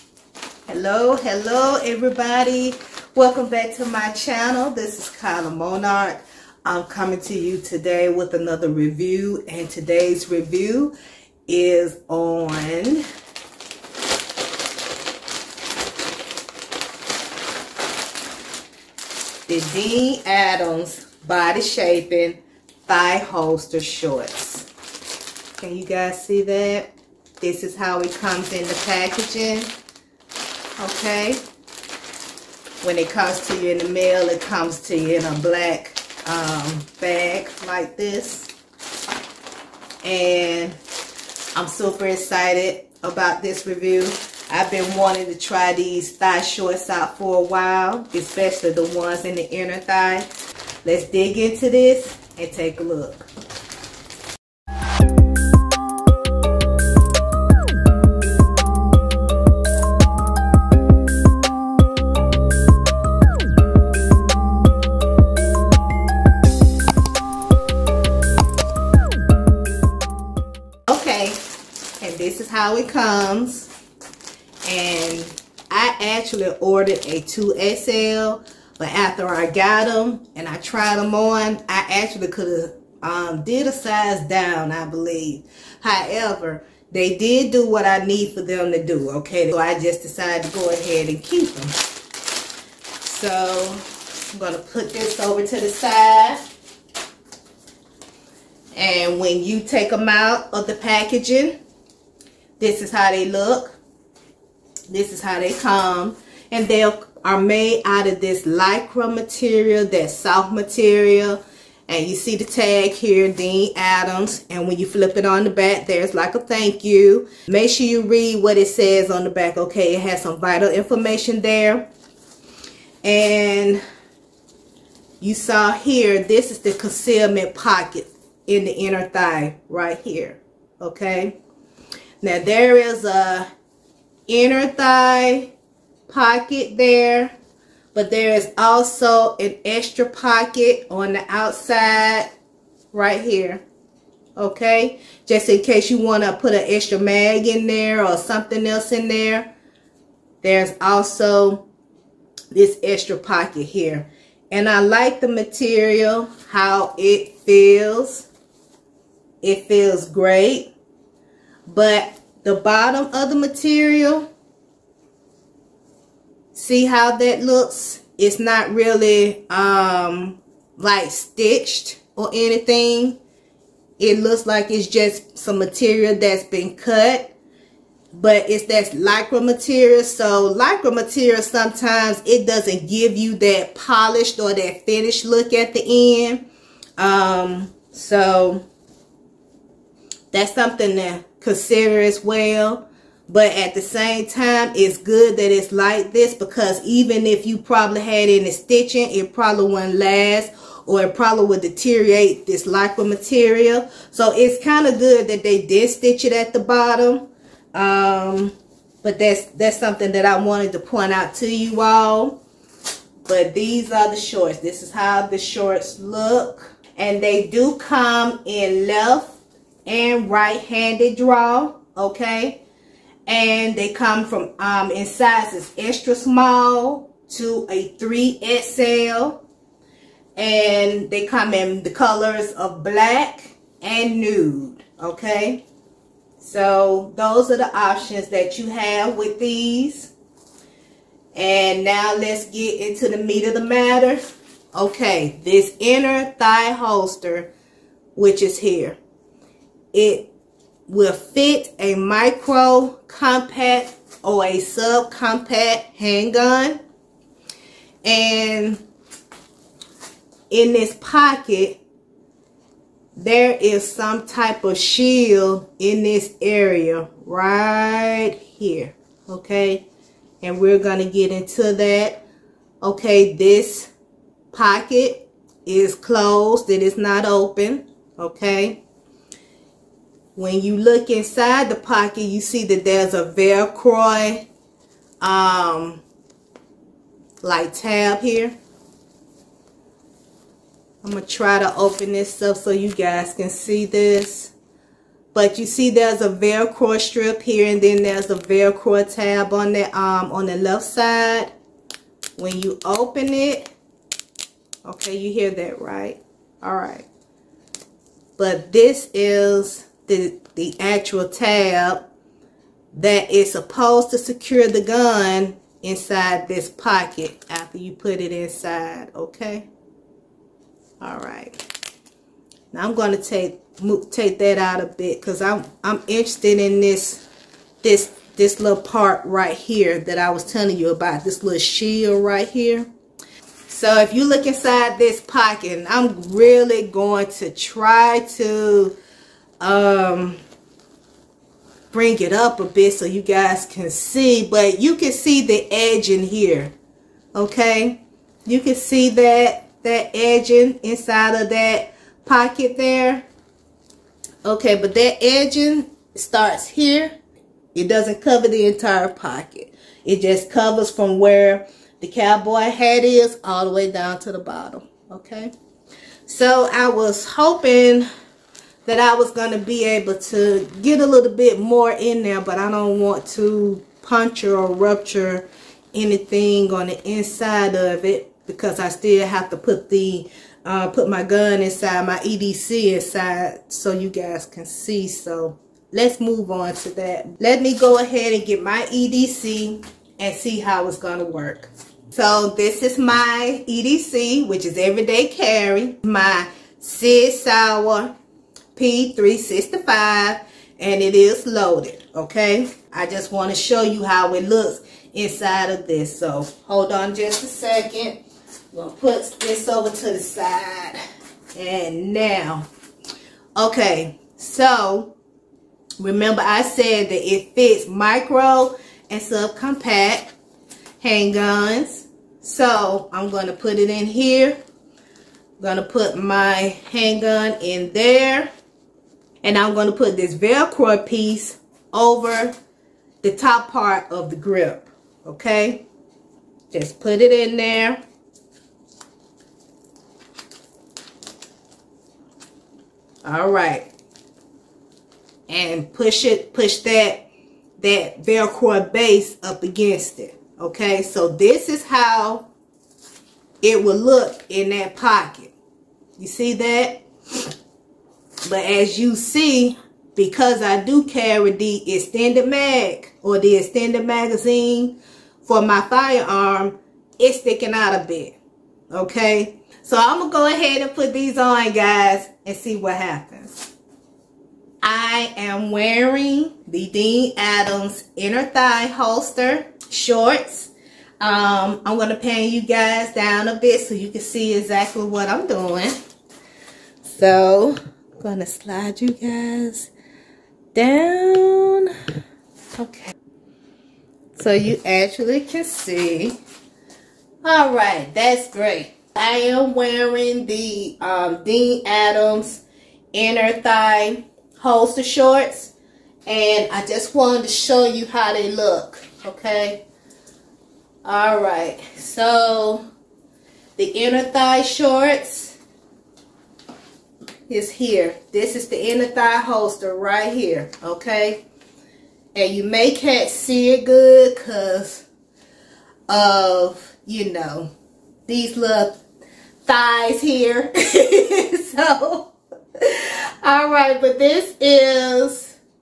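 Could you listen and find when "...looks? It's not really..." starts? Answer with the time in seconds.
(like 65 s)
167 s.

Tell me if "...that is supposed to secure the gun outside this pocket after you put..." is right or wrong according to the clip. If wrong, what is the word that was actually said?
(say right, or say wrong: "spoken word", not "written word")
wrong: "inside", not "outside".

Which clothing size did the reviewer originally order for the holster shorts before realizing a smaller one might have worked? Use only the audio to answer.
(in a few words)
2XL.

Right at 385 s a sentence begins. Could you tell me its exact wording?
So let's move on to that.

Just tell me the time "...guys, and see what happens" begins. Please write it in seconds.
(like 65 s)
471 s.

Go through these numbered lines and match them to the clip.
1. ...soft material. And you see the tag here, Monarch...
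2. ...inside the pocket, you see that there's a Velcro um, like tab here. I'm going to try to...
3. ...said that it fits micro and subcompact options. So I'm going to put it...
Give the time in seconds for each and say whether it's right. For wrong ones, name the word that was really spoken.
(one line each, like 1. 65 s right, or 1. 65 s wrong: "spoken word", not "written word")
1. 110 s wrong: "Dene", not "Monarch"
2. 281 s right
3. 416 s wrong: "handguns", not "options".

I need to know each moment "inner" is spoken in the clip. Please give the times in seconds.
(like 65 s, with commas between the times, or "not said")
49 s, 128 s, 134 s, 245 s, 478 s, 503 s, 513 s, 518 s.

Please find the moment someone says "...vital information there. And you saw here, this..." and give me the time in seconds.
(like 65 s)
120 s.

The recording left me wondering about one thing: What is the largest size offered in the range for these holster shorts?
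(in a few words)
3XL.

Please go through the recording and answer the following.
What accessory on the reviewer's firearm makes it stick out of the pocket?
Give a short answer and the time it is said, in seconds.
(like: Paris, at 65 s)
Extended magazine, at 463 s.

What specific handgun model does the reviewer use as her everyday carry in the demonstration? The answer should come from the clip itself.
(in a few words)
Sig Sauer P365.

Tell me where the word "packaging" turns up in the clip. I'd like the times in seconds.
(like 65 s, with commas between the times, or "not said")
28 s, 100 s.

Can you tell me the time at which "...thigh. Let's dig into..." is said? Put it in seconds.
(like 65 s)
49 s.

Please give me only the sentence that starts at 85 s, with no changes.
However, they did do what I need for them to do, okay?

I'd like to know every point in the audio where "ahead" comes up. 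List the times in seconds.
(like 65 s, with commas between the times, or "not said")
90 s, 387 s, 470 s.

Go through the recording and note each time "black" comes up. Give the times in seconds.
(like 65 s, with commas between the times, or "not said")
35 s, 232 s.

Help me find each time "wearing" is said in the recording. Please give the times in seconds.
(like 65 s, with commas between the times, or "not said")
475 s, 499 s.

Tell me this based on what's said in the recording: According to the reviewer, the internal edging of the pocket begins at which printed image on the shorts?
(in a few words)
Cowboy hat.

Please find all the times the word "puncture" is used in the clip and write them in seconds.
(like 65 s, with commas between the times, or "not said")
374 s.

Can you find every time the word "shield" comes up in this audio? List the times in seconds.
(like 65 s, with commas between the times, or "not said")
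264 s, 331 s.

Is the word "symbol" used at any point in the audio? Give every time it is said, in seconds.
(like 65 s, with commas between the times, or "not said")
not said.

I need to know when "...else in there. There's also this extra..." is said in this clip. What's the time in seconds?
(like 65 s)
148 s.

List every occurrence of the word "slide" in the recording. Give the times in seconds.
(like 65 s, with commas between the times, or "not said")
488 s.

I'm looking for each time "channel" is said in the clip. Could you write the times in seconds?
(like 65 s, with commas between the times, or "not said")
4 s.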